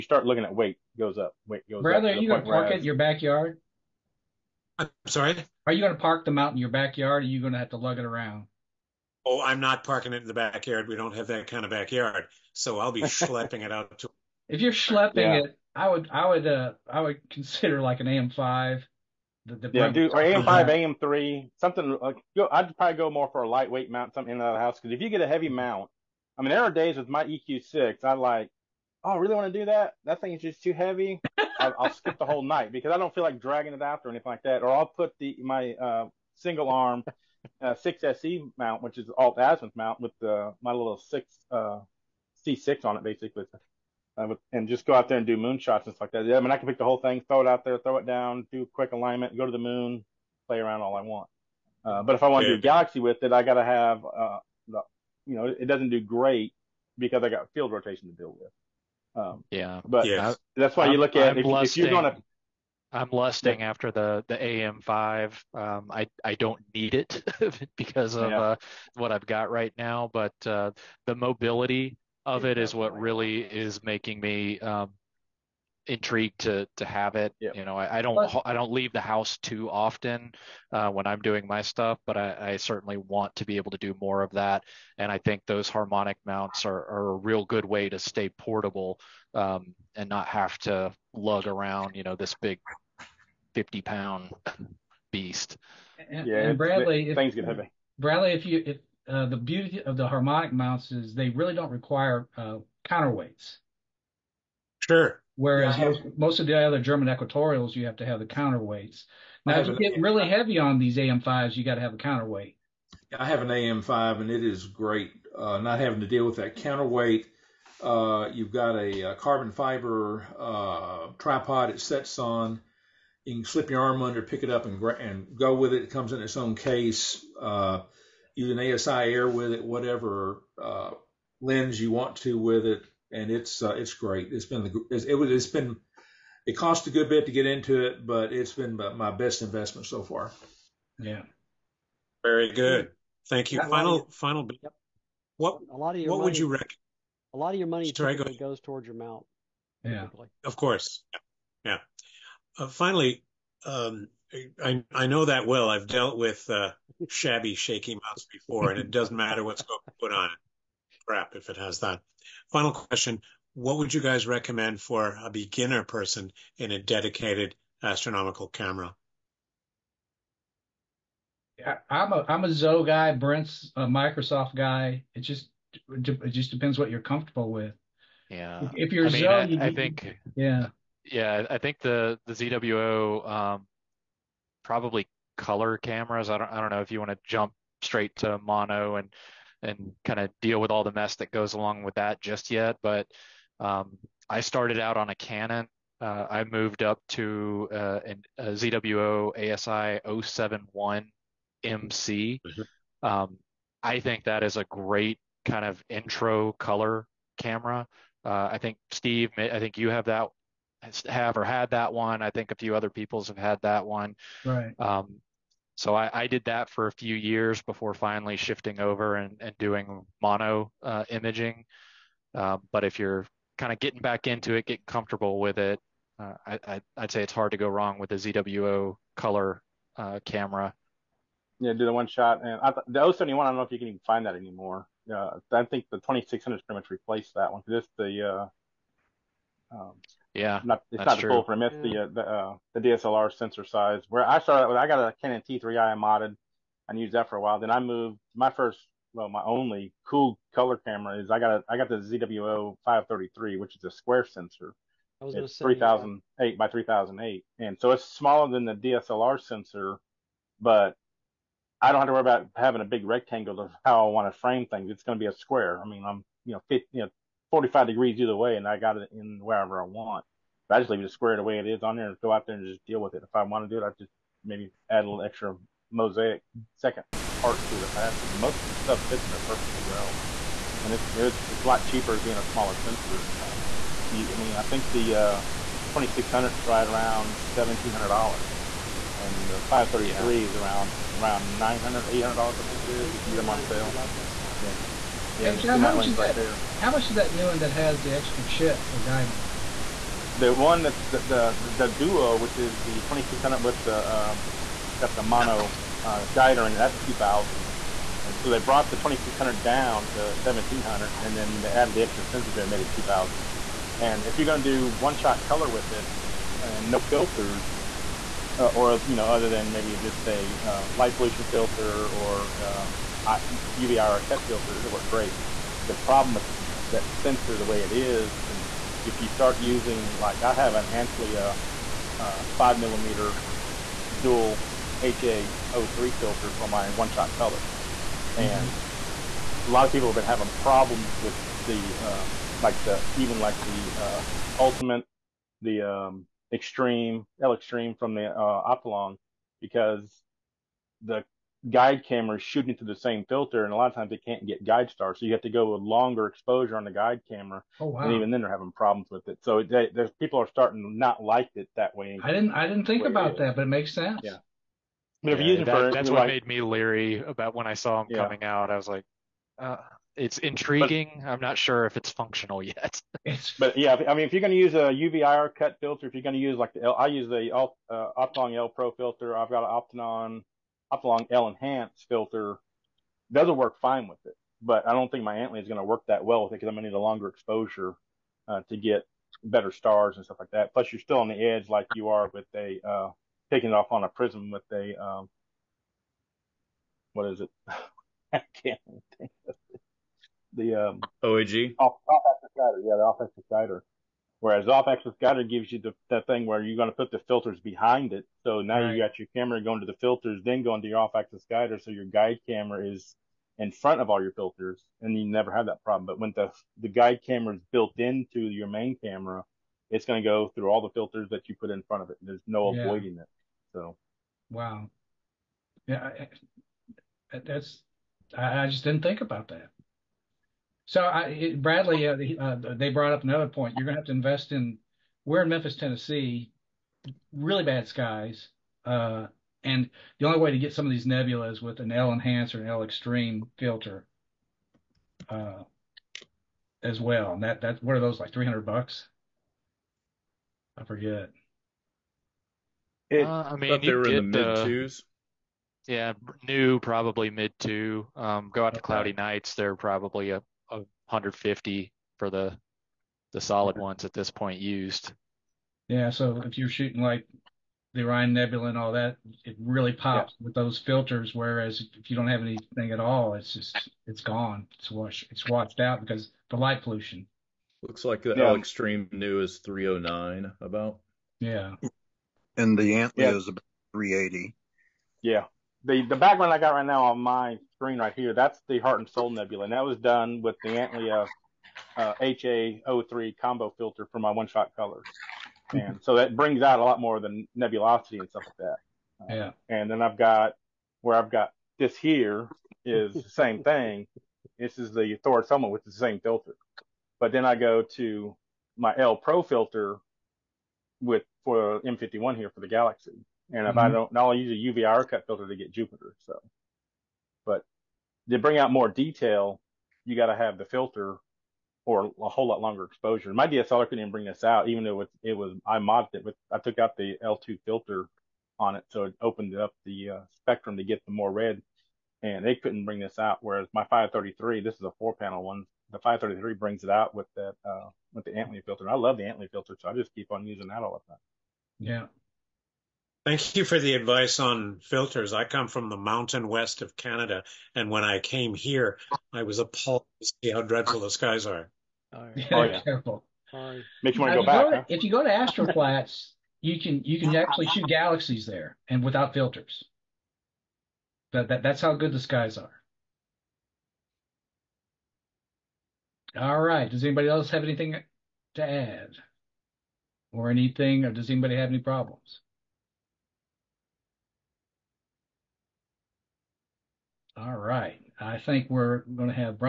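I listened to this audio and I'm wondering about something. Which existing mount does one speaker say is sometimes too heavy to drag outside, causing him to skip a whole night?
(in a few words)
EQ6.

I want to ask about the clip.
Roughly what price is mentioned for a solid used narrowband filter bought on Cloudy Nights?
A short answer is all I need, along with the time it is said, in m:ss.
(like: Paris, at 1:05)
$150, at 7:41.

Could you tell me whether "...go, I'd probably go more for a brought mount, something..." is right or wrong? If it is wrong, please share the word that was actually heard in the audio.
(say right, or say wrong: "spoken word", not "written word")
wrong: "lightweight", not "brought".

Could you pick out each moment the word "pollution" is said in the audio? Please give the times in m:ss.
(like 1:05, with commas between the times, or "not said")
5:21, 7:56.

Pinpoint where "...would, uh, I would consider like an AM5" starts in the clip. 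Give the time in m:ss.
0:16.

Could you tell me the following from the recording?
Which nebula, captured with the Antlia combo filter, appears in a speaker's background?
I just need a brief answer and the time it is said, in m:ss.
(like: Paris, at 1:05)
Heart and Soul Nebula, at 8:08.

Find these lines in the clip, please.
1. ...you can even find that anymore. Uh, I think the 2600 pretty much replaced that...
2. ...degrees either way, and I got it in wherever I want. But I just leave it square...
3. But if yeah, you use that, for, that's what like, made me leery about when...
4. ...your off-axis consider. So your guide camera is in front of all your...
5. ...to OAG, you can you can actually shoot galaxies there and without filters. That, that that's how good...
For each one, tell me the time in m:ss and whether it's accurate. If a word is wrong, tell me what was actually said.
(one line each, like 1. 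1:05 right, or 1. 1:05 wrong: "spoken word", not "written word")
1. 3:53 right
2. 4:27 right
3. 6:05 right
4. 6:50 wrong: "guider", not "consider"
5. 9:15 wrong: "Astroplats", not "OAG".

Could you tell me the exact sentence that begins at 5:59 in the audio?
So they, people are starting to not like it that way.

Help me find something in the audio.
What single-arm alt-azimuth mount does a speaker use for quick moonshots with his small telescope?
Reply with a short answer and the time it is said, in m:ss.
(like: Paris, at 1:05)
6SE, at 0:37.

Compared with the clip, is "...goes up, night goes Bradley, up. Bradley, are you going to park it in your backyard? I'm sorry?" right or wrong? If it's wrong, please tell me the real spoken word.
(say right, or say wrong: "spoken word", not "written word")
wrong: "weight", not "night".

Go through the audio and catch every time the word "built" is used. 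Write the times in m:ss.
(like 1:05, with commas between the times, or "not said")
6:57.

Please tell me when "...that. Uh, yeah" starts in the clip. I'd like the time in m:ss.
8:18.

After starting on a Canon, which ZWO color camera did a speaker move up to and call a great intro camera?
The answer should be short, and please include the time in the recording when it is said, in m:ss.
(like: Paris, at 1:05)
ASI 071 MC, at 3:19.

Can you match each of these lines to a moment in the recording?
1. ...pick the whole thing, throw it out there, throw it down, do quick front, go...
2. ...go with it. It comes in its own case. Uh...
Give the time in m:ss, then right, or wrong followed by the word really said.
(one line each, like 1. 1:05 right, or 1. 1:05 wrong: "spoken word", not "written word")
1. 0:46 wrong: "alignment", not "front"
2. 2:05 right.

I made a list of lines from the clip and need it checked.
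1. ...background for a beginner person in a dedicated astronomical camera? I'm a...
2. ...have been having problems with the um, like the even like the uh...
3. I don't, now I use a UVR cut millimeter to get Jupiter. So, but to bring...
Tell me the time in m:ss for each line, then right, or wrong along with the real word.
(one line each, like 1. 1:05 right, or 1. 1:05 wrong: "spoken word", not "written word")
1. 2:44 wrong: "recommend", not "background"
2. 5:40 right
3. 8:33 wrong: "filter", not "millimeter".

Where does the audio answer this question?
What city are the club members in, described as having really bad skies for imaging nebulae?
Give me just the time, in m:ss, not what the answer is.
7:15.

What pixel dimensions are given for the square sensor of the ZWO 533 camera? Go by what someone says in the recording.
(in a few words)
3008 by 3008.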